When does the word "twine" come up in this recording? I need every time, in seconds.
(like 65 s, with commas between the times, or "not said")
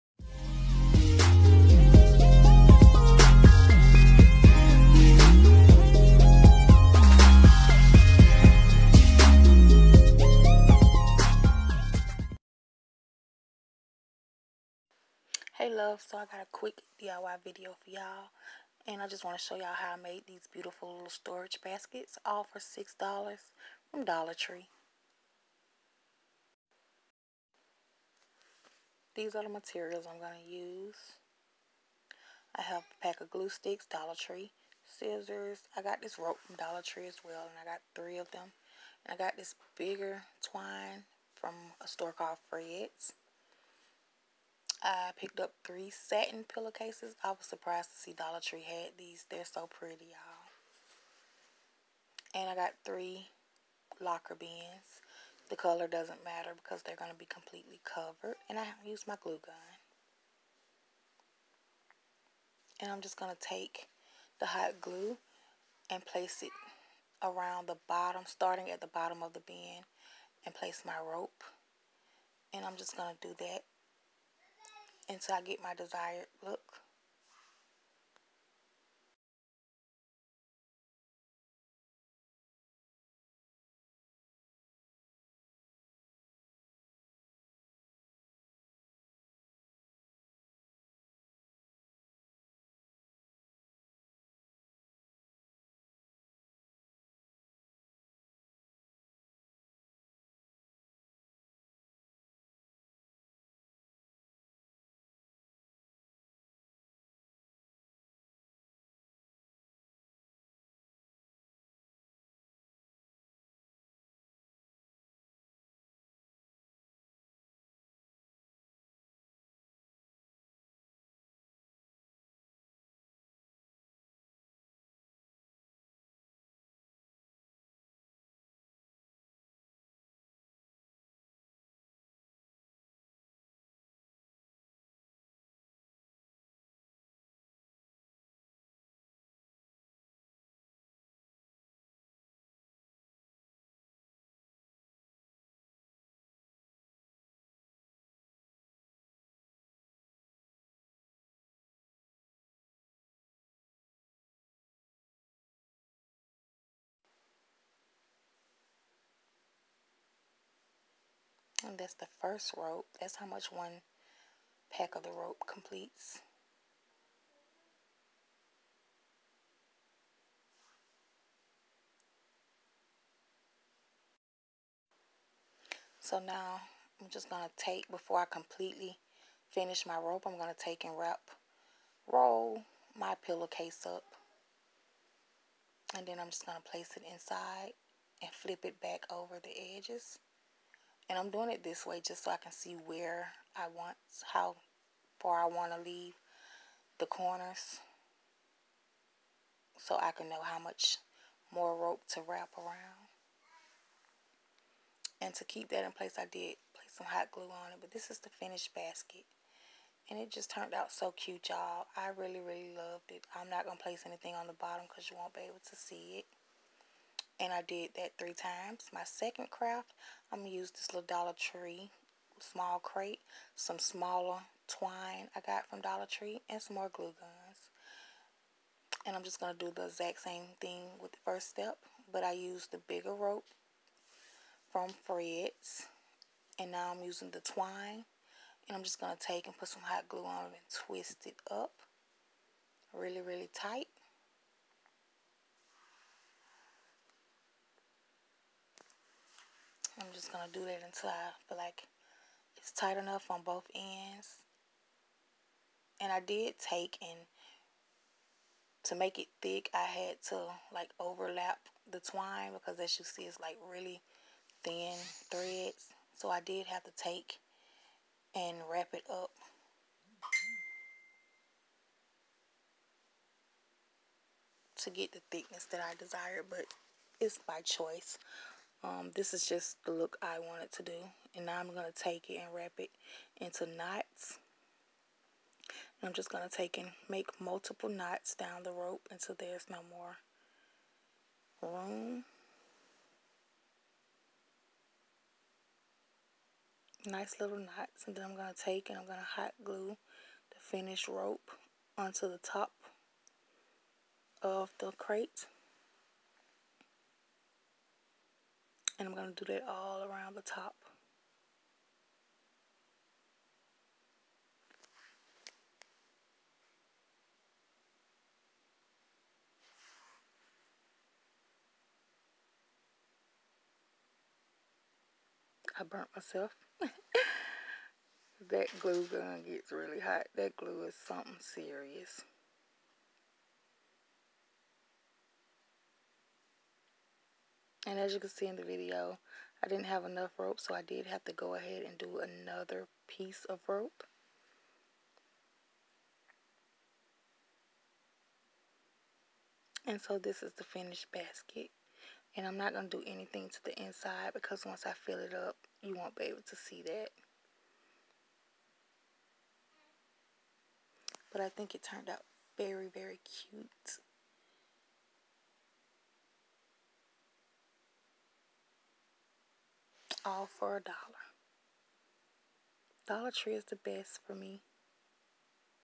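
40 s, 224 s, 237 s, 262 s.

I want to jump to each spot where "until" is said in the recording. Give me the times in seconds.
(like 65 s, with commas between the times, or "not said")
75 s, 250 s, 289 s.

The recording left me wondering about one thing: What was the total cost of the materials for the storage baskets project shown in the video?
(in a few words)
$6.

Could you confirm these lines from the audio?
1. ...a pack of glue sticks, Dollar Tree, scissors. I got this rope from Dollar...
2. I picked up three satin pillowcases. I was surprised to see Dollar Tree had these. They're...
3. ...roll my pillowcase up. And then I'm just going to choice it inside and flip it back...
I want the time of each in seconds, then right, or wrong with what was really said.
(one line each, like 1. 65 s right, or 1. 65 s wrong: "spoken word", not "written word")
1. 32 s right
2. 44 s right
3. 182 s wrong: "place", not "choice".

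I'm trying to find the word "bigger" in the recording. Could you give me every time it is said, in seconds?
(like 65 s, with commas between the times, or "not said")
39 s, 232 s.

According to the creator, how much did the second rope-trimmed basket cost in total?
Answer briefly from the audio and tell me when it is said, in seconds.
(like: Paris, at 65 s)
A dollar, at 370 s.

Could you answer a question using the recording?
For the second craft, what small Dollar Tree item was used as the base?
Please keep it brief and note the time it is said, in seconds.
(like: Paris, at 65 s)
Small crate, at 222 s.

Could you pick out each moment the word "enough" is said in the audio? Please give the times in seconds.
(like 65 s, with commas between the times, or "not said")
252 s, 340 s.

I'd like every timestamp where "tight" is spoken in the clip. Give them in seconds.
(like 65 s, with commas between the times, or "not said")
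243 s, 252 s.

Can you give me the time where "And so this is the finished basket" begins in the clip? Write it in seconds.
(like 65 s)
349 s.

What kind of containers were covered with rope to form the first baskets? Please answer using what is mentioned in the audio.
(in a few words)
Locker bins.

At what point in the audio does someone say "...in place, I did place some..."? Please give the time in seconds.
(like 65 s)
205 s.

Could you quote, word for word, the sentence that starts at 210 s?
And it just turned out so cute, y'all.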